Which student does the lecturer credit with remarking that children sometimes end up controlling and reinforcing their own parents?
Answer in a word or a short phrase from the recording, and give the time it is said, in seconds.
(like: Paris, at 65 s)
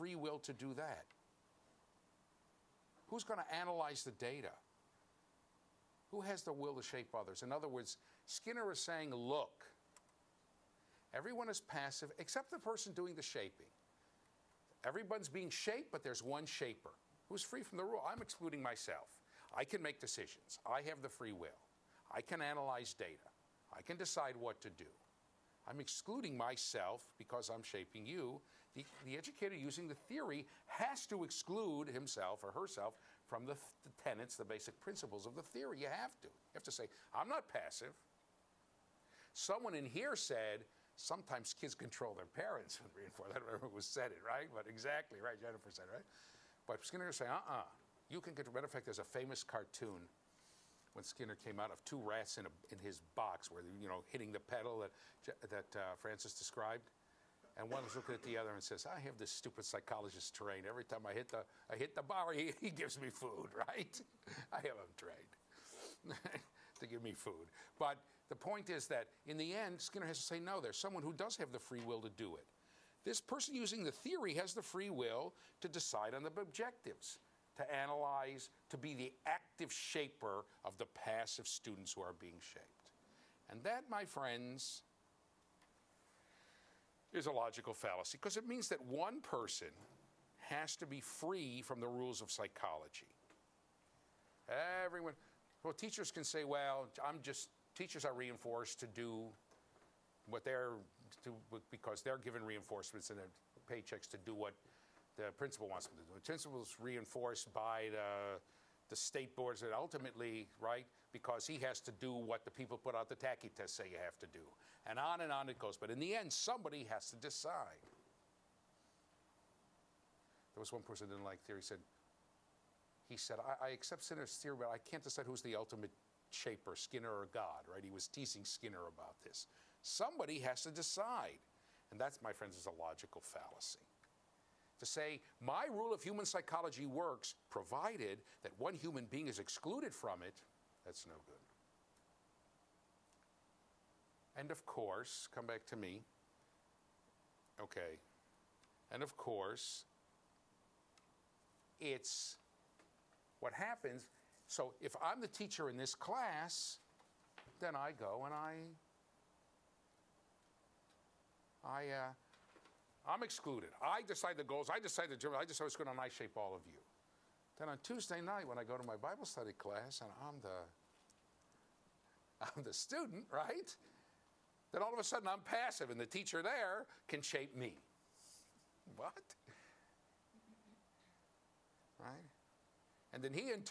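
Jennifer, at 45 s.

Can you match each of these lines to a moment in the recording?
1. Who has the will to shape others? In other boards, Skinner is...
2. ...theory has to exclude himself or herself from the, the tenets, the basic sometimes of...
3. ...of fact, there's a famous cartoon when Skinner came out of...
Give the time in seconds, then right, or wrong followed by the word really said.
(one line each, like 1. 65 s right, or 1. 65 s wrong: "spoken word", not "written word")
1. 6 s wrong: "words", not "boards"
2. 29 s wrong: "principles", not "sometimes"
3. 48 s right.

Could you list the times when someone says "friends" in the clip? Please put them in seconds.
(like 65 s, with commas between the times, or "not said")
84 s, 132 s.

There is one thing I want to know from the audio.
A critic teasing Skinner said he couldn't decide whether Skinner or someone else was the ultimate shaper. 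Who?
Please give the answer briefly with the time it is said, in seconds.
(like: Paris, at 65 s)
God, at 127 s.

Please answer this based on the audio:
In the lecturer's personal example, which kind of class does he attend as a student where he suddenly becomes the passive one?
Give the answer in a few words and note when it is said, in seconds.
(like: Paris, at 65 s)
Bible study class, at 168 s.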